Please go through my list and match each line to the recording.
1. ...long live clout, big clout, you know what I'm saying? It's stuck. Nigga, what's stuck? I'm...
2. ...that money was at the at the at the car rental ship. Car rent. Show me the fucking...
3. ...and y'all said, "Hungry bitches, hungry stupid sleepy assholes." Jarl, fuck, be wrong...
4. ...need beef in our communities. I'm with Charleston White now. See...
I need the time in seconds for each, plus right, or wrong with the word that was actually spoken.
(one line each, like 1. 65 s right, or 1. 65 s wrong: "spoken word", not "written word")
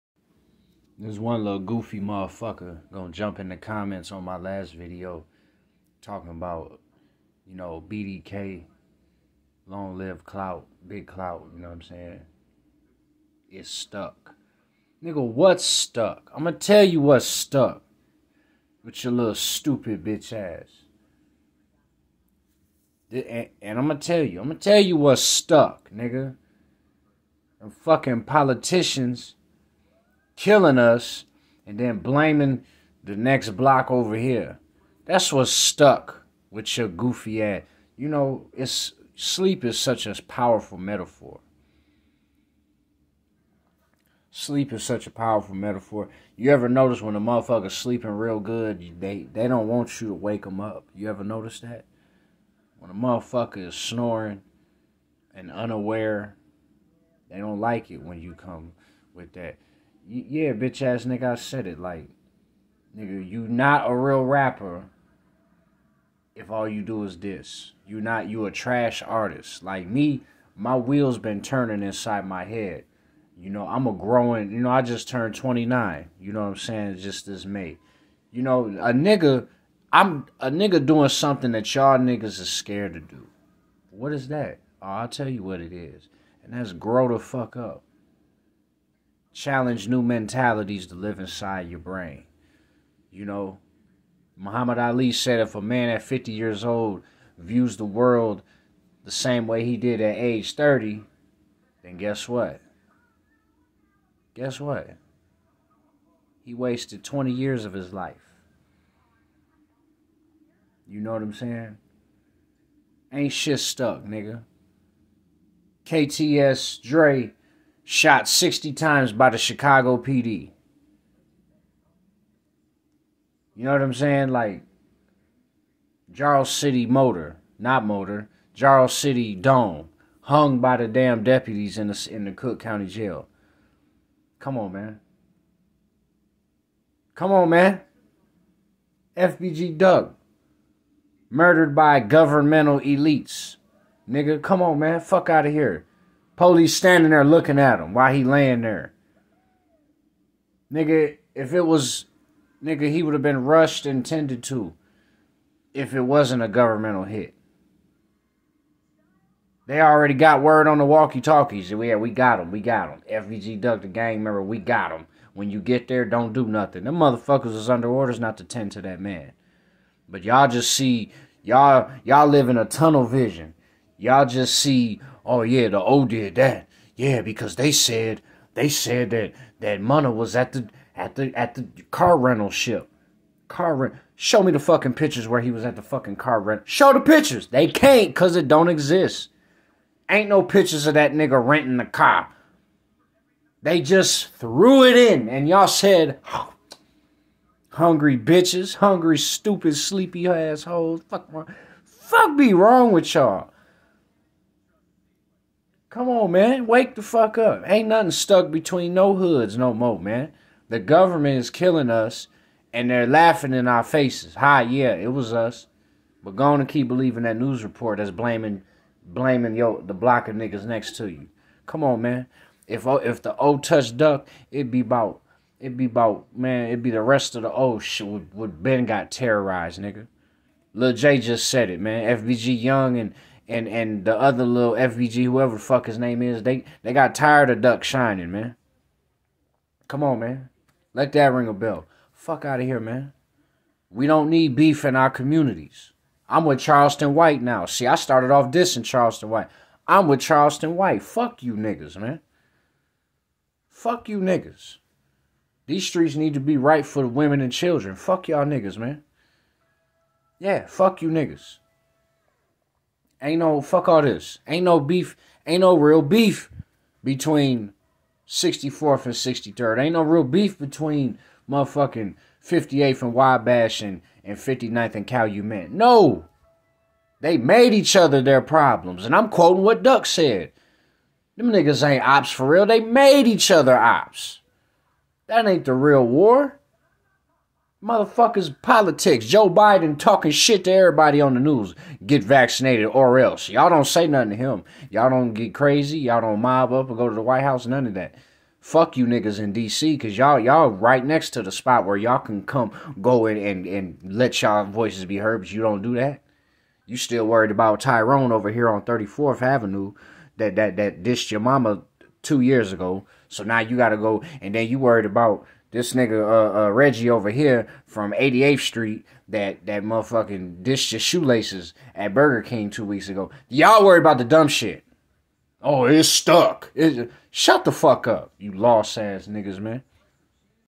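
1. 9 s right
2. 179 s right
3. 195 s wrong: "Fuck", not "Jarl"
4. 244 s right.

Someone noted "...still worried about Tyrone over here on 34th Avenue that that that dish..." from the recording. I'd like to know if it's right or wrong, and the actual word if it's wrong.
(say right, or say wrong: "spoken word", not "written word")
right.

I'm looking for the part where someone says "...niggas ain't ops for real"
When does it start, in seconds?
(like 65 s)
281 s.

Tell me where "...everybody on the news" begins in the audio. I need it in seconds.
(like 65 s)
290 s.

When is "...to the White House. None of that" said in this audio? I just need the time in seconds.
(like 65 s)
297 s.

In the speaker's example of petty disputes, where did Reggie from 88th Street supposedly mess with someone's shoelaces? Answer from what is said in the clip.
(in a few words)
Burger King.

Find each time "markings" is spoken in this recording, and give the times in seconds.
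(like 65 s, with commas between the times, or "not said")
not said.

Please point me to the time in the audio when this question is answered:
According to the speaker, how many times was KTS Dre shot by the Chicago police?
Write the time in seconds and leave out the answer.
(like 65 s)
118 s.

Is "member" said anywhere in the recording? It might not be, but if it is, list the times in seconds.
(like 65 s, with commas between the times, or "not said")
164 s.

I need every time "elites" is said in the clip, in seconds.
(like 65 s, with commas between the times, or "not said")
142 s.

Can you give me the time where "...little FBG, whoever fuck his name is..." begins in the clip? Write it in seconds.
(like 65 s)
234 s.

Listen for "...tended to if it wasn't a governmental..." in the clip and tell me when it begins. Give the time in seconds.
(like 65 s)
154 s.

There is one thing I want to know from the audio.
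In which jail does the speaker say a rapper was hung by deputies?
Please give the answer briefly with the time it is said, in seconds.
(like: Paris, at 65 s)
Cook County Jail, at 132 s.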